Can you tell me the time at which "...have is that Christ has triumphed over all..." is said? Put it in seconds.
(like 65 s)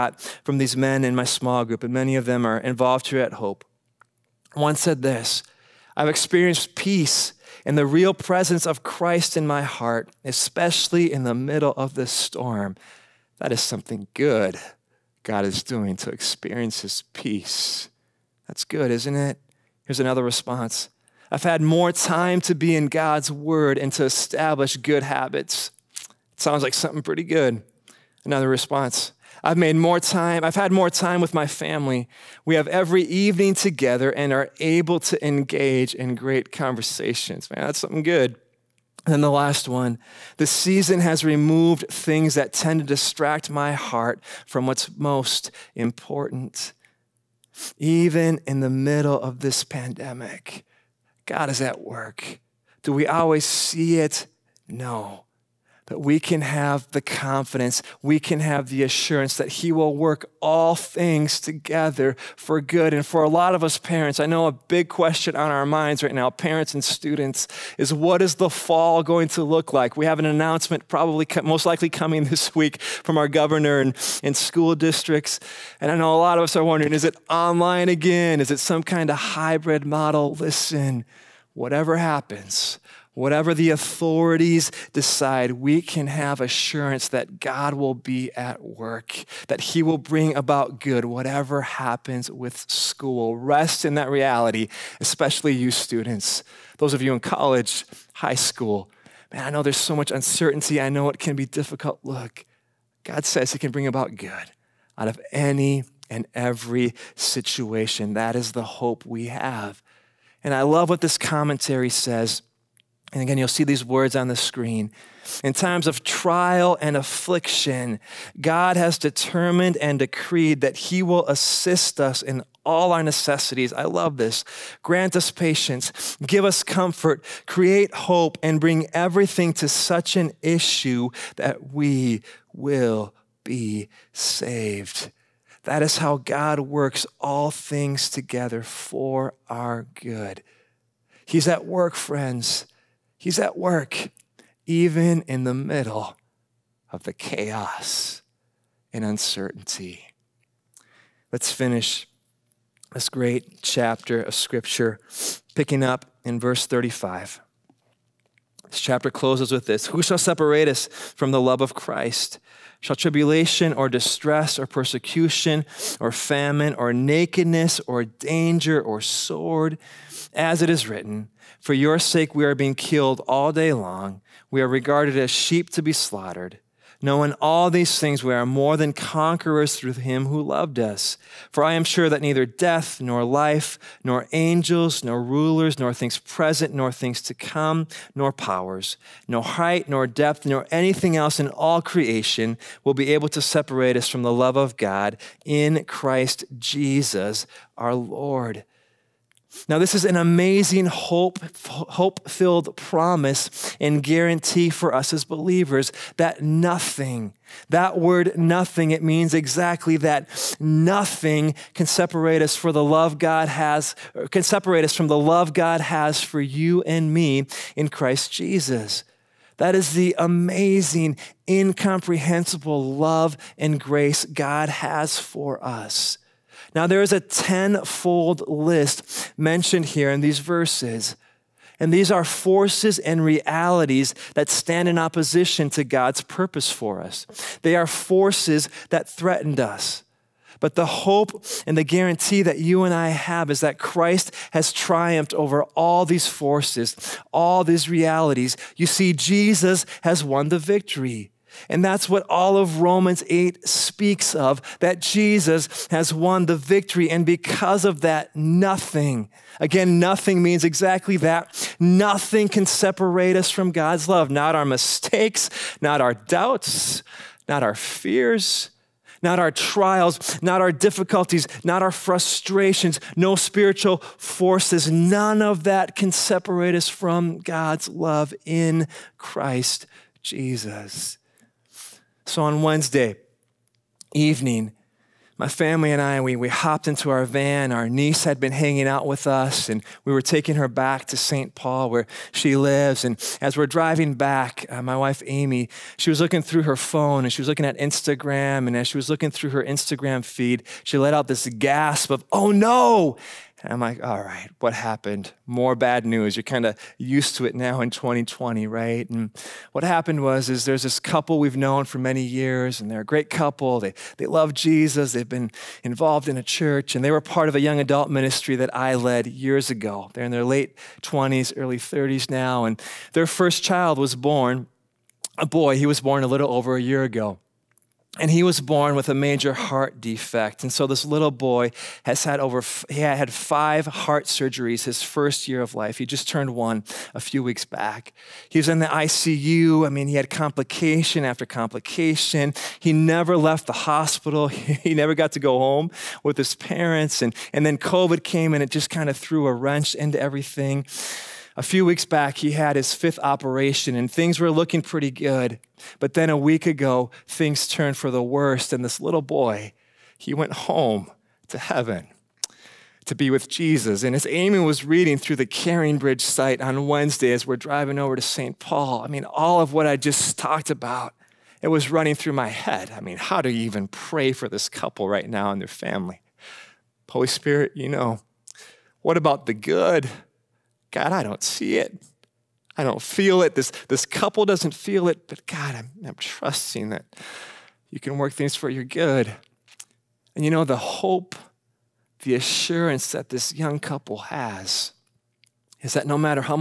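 243 s.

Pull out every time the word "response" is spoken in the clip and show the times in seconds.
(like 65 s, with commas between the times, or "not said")
20 s, 28 s.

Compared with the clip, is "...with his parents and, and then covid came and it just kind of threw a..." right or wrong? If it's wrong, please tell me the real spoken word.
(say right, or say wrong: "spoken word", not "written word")
right.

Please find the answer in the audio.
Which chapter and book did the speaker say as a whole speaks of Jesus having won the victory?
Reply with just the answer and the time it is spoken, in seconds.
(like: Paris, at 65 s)
Romans 8, at 252 s.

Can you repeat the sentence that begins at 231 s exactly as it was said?
And these are forces and realities that stand in opposition to God's purpose for us.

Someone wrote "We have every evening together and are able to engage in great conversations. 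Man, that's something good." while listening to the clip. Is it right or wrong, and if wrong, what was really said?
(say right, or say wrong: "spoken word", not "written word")
right.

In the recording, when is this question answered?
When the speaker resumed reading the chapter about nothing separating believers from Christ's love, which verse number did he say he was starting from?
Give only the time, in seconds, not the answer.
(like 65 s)
156 s.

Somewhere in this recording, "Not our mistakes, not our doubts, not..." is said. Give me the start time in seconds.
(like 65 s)
264 s.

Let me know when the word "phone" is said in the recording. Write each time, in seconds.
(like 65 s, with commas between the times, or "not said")
296 s.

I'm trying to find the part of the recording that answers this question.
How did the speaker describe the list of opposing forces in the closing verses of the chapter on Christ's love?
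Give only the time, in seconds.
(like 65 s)
227 s.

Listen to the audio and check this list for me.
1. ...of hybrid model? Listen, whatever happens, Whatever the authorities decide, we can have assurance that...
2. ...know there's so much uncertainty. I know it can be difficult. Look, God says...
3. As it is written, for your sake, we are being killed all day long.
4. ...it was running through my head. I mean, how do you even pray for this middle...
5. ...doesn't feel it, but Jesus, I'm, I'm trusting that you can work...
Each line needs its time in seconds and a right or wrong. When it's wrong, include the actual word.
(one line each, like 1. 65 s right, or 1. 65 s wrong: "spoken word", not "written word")
1. 79 s right
2. 99 s right
3. 170 s right
4. 371 s wrong: "couple", not "middle"
5. 384 s wrong: "God", not "Jesus".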